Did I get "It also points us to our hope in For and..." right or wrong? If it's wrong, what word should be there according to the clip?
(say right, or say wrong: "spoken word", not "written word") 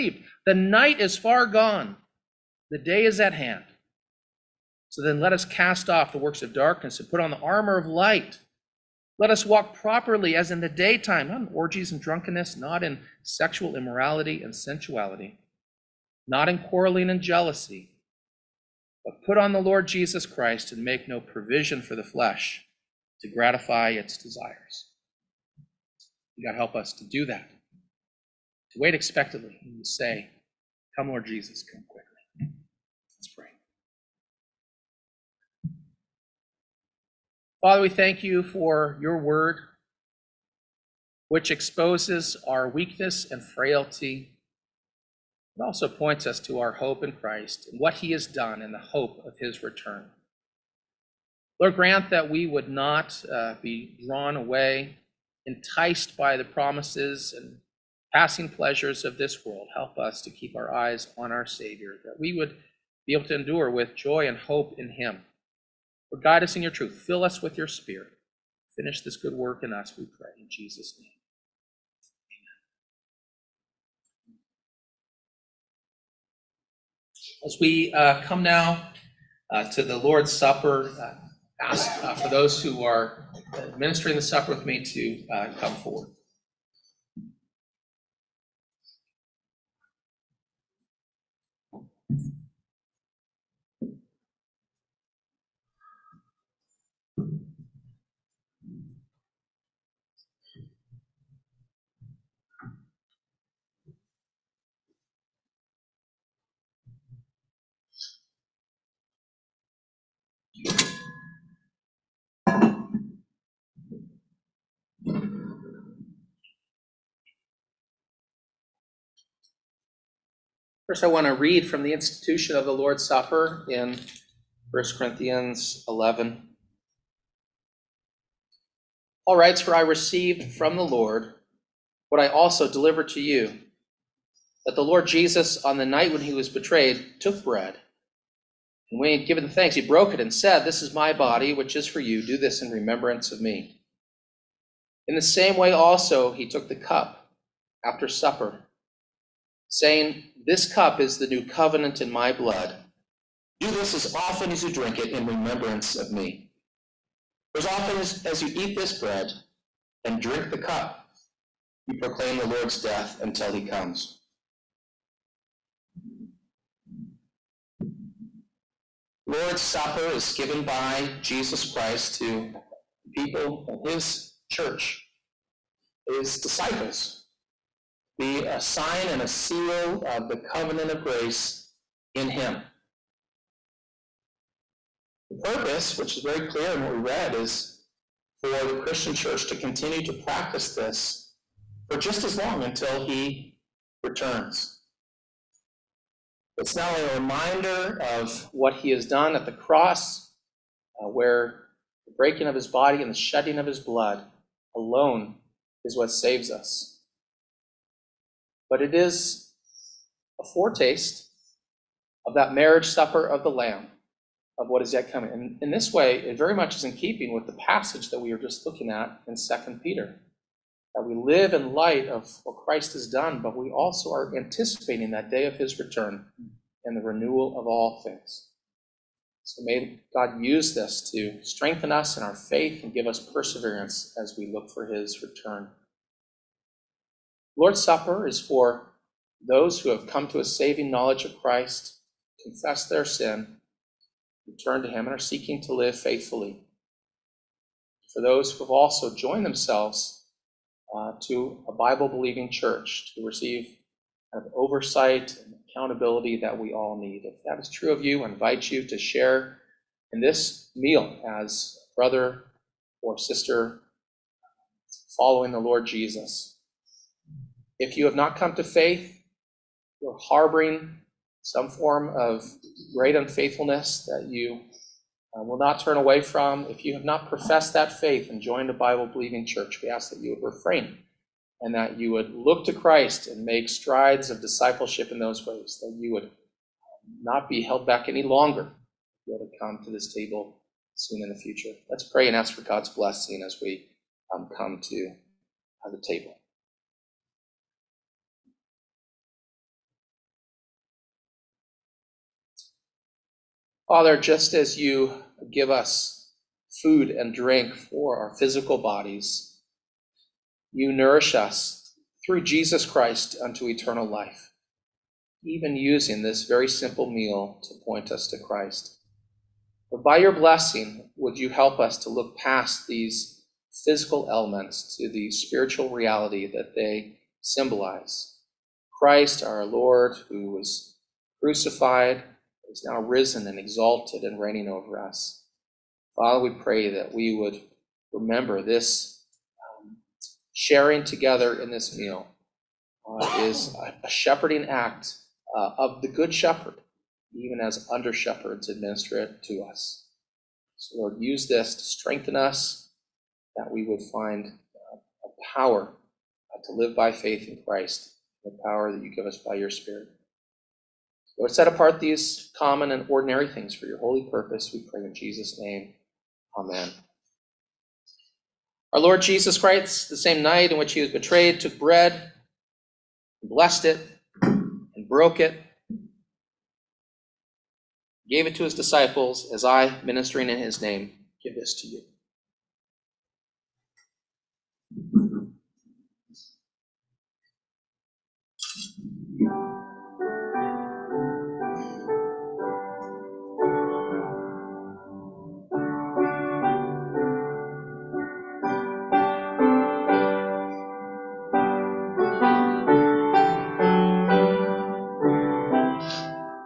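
wrong: "Christ", not "For".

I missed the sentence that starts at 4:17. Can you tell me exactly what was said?
If that is true of you, I invite you to share in this meal as brother or sister following the Lord Jesus.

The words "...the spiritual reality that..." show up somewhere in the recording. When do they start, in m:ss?
5:25.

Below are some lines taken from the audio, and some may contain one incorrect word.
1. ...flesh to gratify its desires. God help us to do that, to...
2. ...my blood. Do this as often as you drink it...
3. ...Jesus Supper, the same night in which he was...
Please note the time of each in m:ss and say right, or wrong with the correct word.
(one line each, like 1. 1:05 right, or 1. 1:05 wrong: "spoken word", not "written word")
1. 0:22 right
2. 2:32 right
3. 6:09 wrong: "Christ", not "Supper".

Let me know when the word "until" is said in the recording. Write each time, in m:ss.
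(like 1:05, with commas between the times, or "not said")
2:43, 3:12.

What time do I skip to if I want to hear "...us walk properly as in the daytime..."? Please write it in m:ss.
0:09.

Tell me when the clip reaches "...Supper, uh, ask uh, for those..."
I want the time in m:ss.
1:20.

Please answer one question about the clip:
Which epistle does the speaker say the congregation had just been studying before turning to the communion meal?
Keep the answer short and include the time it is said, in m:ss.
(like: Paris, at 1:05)
2 Peter, at 3:39.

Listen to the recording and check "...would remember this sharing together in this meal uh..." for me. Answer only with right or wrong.
right.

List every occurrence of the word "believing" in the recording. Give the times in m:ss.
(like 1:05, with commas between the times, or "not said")
4:12, 4:39.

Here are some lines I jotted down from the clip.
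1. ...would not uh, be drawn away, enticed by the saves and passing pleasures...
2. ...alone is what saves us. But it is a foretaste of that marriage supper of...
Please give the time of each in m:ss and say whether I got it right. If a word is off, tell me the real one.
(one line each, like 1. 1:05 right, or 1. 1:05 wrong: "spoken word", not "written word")
1. 0:52 wrong: "promises", not "saves"
2. 3:24 right.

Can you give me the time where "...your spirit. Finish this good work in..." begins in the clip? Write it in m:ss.
1:07.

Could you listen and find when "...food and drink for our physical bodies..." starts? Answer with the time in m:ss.
5:06.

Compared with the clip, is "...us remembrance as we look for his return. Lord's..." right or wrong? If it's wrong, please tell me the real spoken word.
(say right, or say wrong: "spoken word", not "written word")
wrong: "perseverance", not "remembrance".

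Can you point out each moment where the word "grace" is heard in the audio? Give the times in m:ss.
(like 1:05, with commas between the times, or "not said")
3:01.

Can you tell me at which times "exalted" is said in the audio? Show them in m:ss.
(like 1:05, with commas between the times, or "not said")
5:33.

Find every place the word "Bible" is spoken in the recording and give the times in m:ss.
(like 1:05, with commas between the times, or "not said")
4:11, 4:38.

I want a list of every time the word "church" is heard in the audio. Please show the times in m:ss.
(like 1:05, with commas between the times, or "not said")
2:54, 3:09, 4:12, 4:39.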